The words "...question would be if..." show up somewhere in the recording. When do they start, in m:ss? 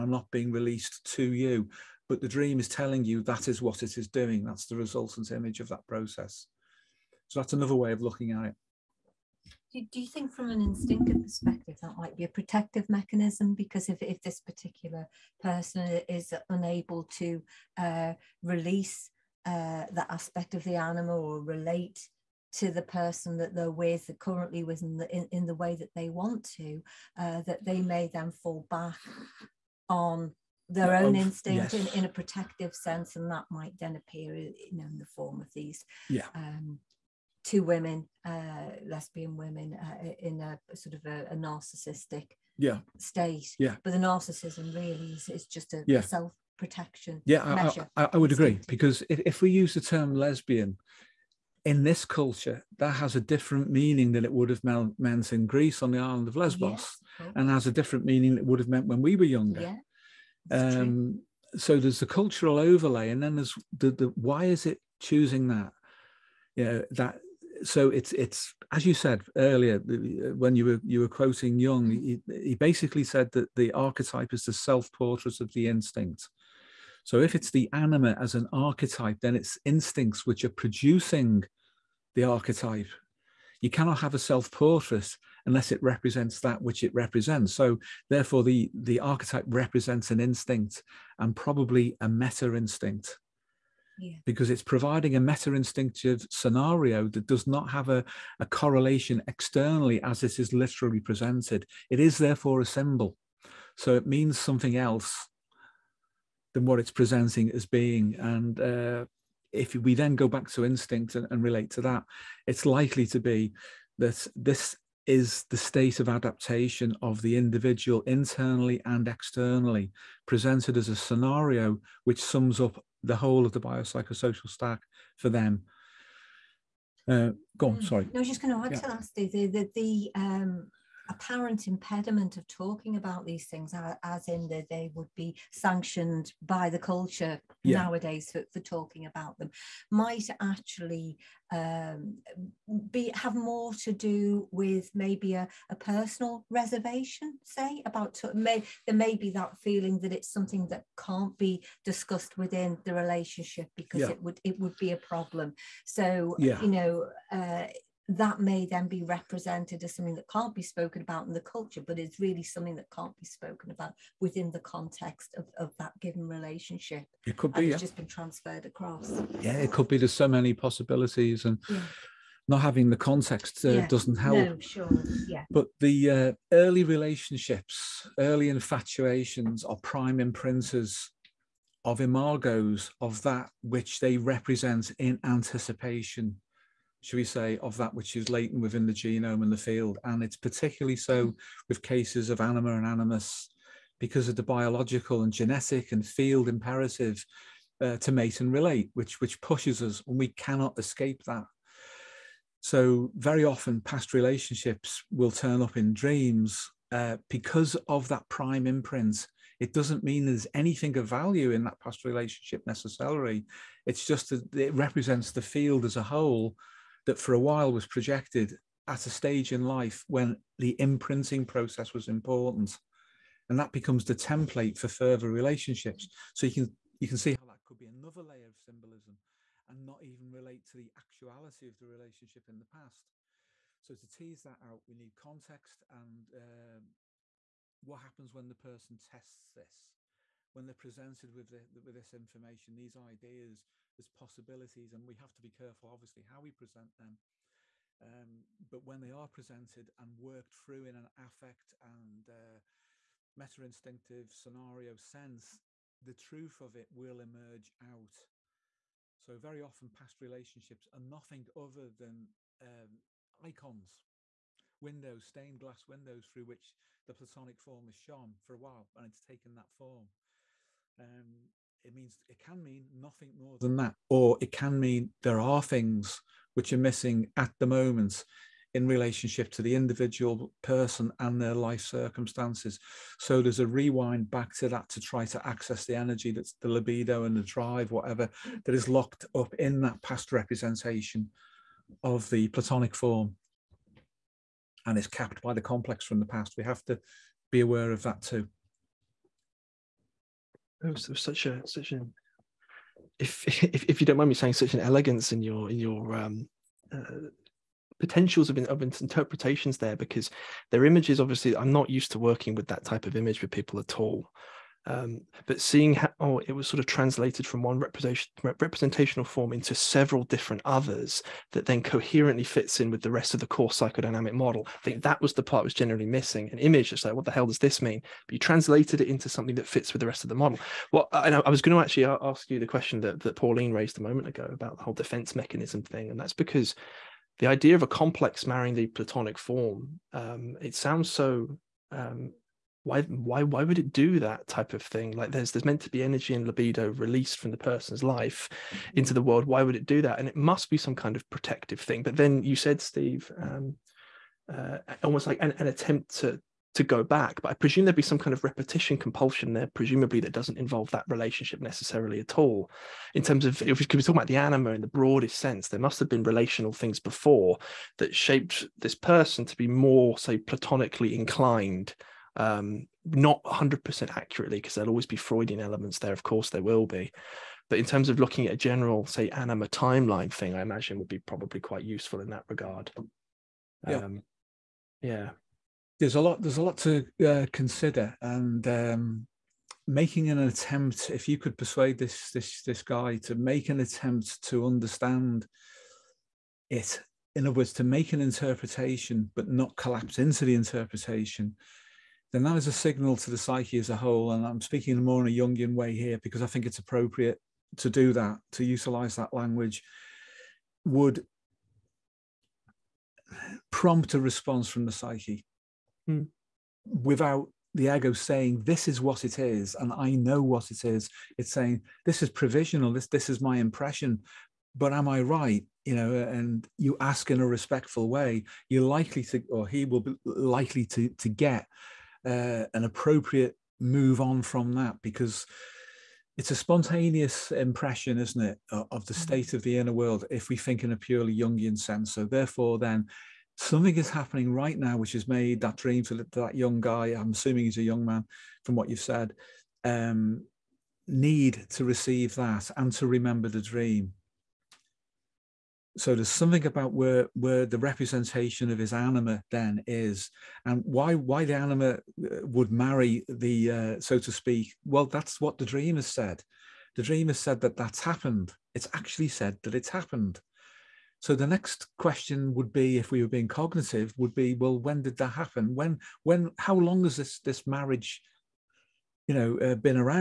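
7:51.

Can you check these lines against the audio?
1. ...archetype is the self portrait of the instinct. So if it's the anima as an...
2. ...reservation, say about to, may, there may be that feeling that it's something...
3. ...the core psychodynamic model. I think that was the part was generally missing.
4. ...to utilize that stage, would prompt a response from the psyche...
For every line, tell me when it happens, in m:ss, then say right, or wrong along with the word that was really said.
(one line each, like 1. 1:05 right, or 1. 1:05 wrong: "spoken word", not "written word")
1. 1:13 right
2. 2:26 right
3. 5:23 right
4. 6:48 wrong: "language", not "stage".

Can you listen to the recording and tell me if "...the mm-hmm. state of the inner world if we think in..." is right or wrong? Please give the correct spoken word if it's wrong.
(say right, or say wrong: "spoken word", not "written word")
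right.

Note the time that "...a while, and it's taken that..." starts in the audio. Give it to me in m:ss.
4:28.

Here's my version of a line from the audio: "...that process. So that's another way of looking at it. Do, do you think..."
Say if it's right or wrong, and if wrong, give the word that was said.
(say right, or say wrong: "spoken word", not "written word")
right.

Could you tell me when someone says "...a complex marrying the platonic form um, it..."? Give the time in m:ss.
5:37.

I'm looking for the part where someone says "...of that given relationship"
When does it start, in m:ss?
2:45.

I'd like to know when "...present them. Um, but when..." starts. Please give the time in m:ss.
4:06.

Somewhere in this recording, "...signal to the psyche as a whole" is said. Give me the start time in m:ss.
6:42.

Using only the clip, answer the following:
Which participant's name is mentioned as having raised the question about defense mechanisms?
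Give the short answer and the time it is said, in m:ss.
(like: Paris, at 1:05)
Pauline, at 5:33.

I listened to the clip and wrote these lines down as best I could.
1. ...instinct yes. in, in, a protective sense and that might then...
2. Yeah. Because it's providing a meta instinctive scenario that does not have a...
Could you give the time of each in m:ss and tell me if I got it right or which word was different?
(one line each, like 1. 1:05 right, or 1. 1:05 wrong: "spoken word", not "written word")
1. 0:31 right
2. 1:34 right.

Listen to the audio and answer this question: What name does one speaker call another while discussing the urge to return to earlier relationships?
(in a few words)
Steve.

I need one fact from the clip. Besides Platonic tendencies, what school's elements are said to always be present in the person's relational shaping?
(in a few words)
Freudian.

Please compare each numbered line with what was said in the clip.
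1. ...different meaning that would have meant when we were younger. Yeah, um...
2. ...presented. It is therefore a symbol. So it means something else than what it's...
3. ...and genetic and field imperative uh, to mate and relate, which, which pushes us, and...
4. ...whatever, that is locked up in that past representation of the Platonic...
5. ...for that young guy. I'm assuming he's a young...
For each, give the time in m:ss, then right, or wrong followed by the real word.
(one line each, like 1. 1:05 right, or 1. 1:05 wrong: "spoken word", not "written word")
1. 0:57 right
2. 1:41 right
3. 3:15 right
4. 4:47 right
5. 7:26 right.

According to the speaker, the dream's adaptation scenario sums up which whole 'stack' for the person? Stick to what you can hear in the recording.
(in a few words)
Biopsychosocial stack.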